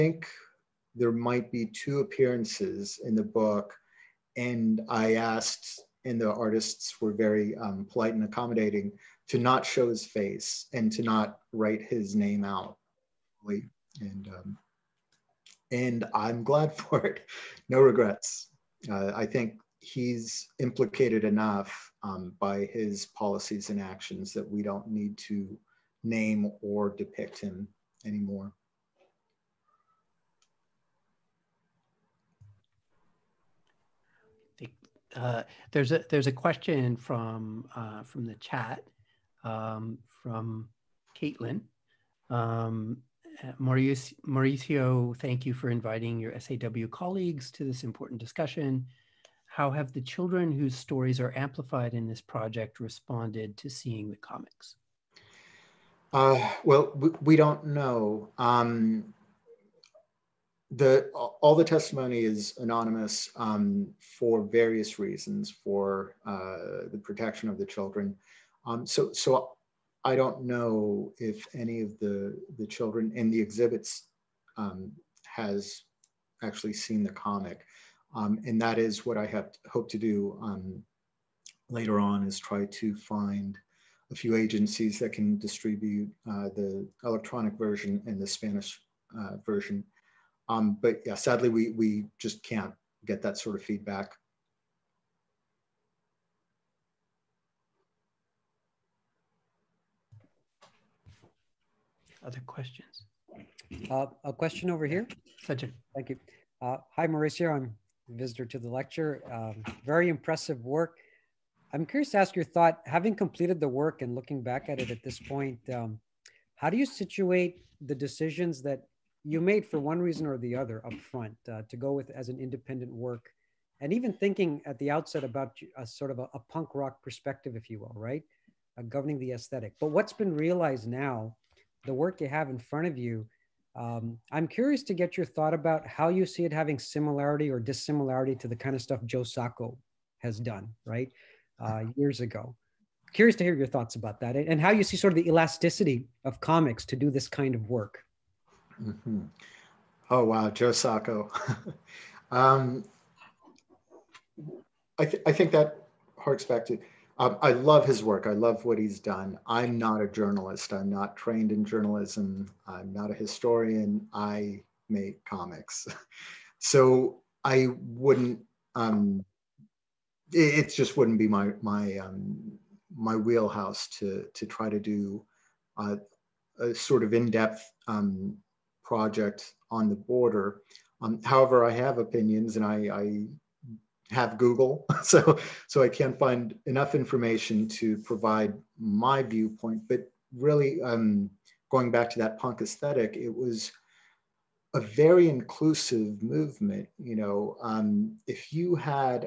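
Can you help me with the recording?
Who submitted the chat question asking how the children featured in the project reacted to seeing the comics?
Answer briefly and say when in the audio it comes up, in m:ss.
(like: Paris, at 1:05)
Caitlin, at 0:41.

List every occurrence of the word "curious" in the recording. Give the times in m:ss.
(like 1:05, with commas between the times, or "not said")
1:51, 2:14, 2:23.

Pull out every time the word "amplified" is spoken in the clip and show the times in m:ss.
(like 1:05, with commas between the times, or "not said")
0:51.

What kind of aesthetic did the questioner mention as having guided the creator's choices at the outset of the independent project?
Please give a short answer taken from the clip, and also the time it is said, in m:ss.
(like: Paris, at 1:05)
punk rock, at 2:06.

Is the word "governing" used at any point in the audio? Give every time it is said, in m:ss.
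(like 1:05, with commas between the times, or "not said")
2:08.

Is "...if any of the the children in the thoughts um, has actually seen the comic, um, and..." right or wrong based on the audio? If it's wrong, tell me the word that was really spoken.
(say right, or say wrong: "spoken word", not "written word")
wrong: "exhibits", not "thoughts".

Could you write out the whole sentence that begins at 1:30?
Um, but yeah, sadly, we, we just can't get that sort of feedback.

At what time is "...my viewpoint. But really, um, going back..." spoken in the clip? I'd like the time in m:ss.
3:08.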